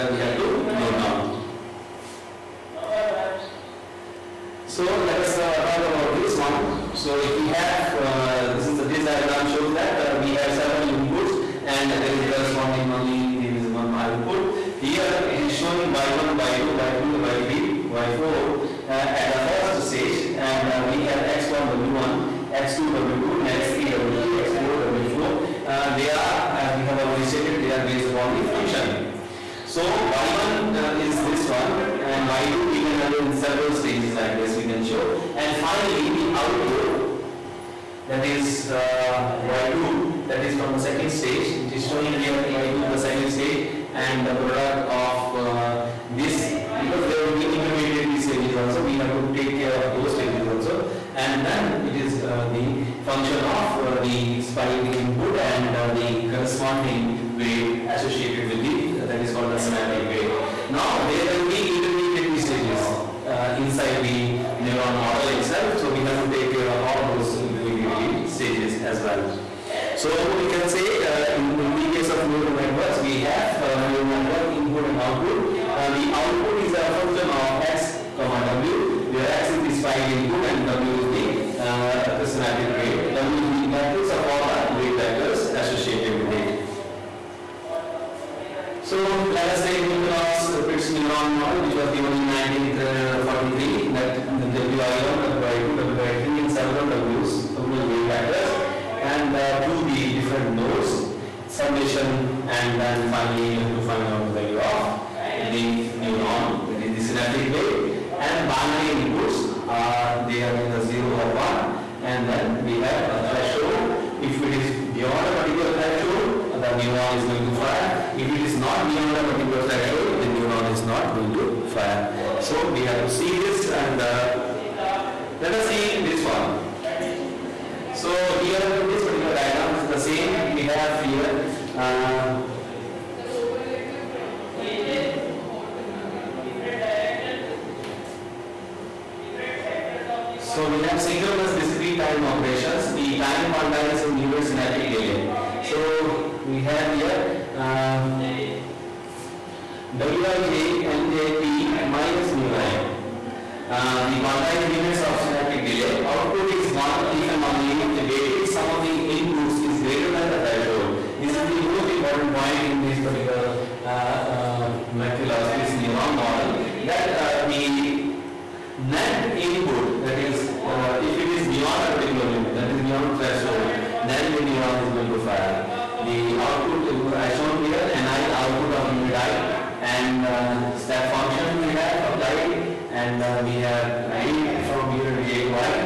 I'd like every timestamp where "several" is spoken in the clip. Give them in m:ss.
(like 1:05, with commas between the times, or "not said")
0:10, 0:33, 1:36.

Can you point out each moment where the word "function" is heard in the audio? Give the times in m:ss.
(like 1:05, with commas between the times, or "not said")
0:28, 0:53, 1:16, 3:01.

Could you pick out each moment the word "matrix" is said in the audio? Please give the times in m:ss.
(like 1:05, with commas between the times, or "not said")
1:23.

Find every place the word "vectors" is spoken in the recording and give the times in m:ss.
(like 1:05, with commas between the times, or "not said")
1:24, 1:38.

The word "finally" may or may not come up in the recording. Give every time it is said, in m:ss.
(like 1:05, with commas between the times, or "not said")
0:35, 1:43.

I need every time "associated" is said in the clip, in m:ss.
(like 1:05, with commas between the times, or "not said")
0:57, 1:25.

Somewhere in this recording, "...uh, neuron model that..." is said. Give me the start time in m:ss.
2:43.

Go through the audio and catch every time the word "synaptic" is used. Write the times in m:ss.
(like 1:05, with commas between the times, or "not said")
0:59, 1:22, 1:47, 2:24, 2:35.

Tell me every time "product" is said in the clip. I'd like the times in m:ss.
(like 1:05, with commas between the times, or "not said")
0:44.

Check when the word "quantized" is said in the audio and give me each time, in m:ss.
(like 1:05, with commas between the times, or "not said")
2:23, 2:34.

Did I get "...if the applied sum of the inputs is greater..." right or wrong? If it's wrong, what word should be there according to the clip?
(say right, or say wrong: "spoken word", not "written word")
wrong: "weighted", not "applied".